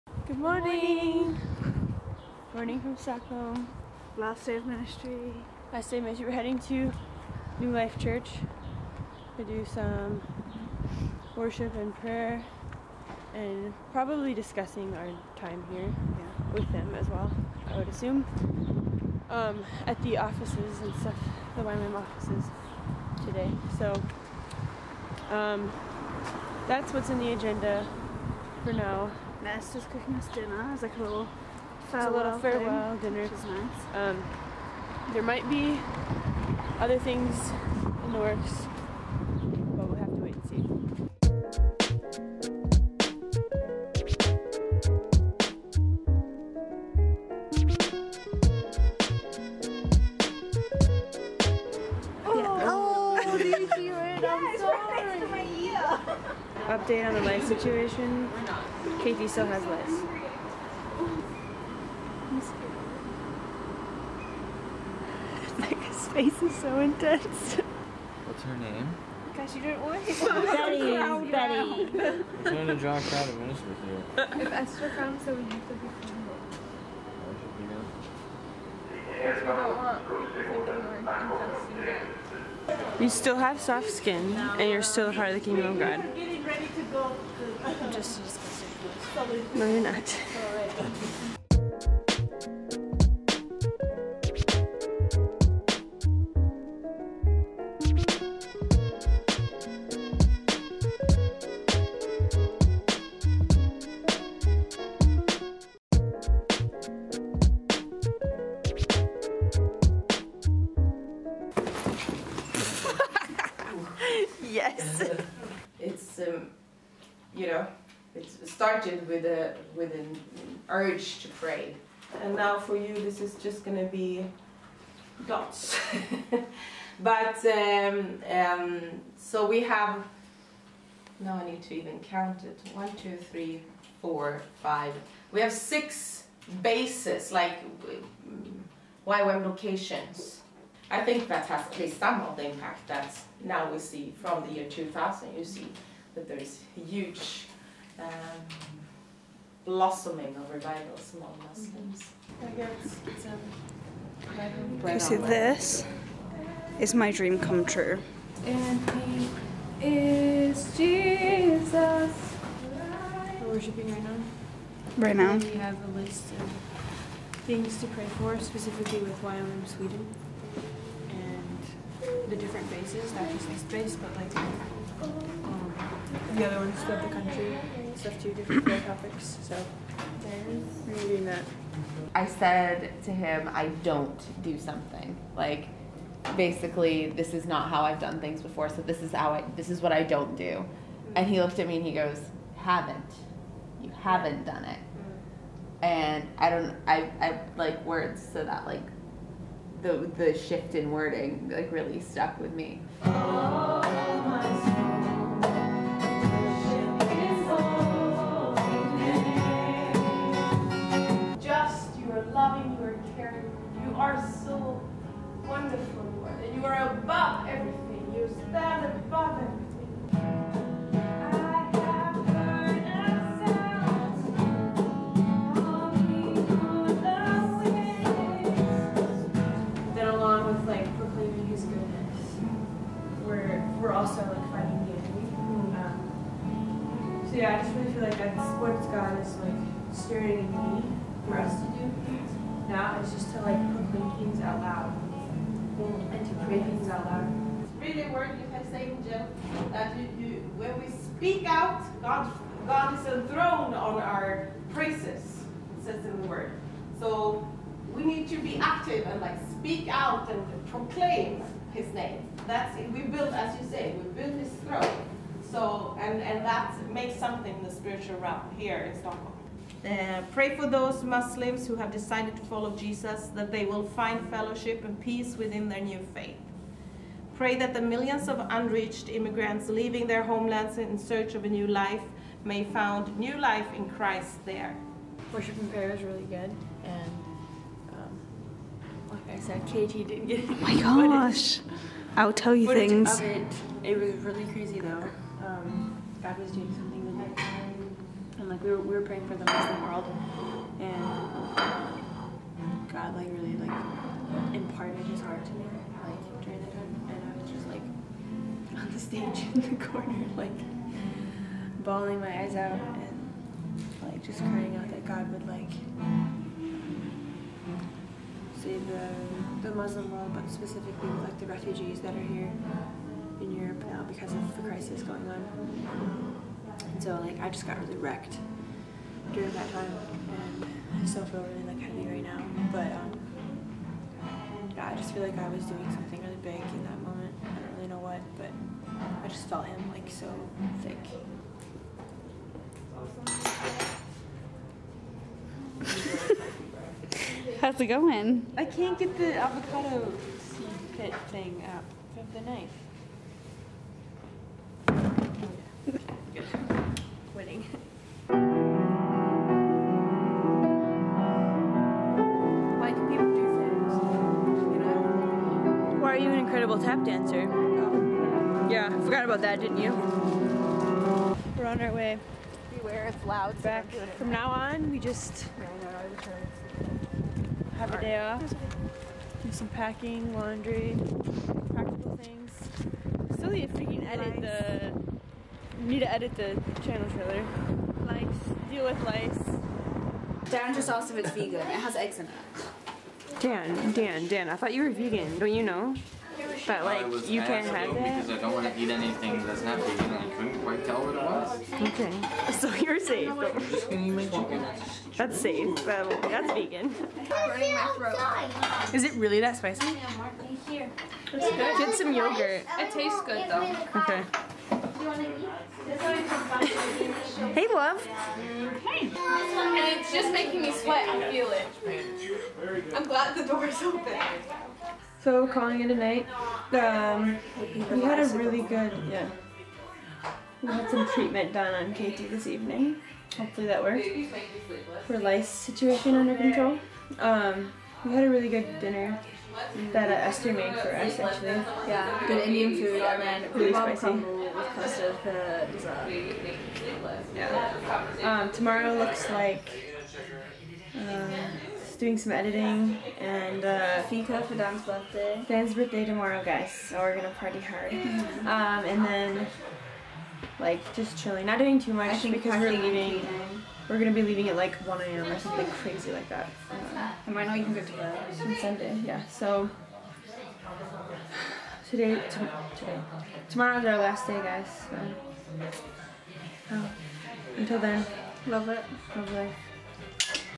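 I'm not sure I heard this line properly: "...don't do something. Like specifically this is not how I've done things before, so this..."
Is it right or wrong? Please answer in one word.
wrong.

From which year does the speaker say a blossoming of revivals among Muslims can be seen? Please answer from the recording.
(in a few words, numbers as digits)
2000.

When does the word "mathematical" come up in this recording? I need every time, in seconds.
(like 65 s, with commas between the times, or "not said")
not said.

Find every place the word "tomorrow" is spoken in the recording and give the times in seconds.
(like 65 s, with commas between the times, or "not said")
448 s, 456 s, 473 s.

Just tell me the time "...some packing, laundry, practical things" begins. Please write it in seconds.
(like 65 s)
379 s.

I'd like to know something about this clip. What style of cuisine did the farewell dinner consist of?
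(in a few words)
Indian.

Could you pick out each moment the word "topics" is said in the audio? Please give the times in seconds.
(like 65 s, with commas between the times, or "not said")
178 s.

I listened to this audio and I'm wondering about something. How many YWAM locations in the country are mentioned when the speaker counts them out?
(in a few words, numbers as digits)
6.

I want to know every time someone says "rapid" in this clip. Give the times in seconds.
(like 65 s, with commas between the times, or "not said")
not said.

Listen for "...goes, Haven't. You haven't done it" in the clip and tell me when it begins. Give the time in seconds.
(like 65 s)
191 s.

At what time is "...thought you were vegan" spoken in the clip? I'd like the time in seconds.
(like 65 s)
394 s.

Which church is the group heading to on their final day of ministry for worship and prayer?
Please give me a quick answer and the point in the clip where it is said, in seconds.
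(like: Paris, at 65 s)
New Life Church, at 7 s.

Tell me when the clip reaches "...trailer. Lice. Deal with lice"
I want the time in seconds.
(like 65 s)
387 s.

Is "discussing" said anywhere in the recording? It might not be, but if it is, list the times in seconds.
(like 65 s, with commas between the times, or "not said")
14 s.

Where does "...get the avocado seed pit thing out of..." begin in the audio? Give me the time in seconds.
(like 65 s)
348 s.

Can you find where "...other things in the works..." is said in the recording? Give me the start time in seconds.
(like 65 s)
36 s.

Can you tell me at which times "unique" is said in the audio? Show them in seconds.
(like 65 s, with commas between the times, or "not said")
not said.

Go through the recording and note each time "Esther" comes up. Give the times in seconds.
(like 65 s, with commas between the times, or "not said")
29 s, 74 s, 440 s.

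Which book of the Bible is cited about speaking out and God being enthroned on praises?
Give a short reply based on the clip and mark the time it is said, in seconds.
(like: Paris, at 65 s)
Job, at 249 s.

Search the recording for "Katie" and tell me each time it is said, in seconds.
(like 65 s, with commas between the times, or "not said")
59 s, 289 s, 431 s.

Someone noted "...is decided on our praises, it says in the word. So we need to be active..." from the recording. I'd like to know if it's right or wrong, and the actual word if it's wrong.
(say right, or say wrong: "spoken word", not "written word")
wrong: "enthroned", not "decided".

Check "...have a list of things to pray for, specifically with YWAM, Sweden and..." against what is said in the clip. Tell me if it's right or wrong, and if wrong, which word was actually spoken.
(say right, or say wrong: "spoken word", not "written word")
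right.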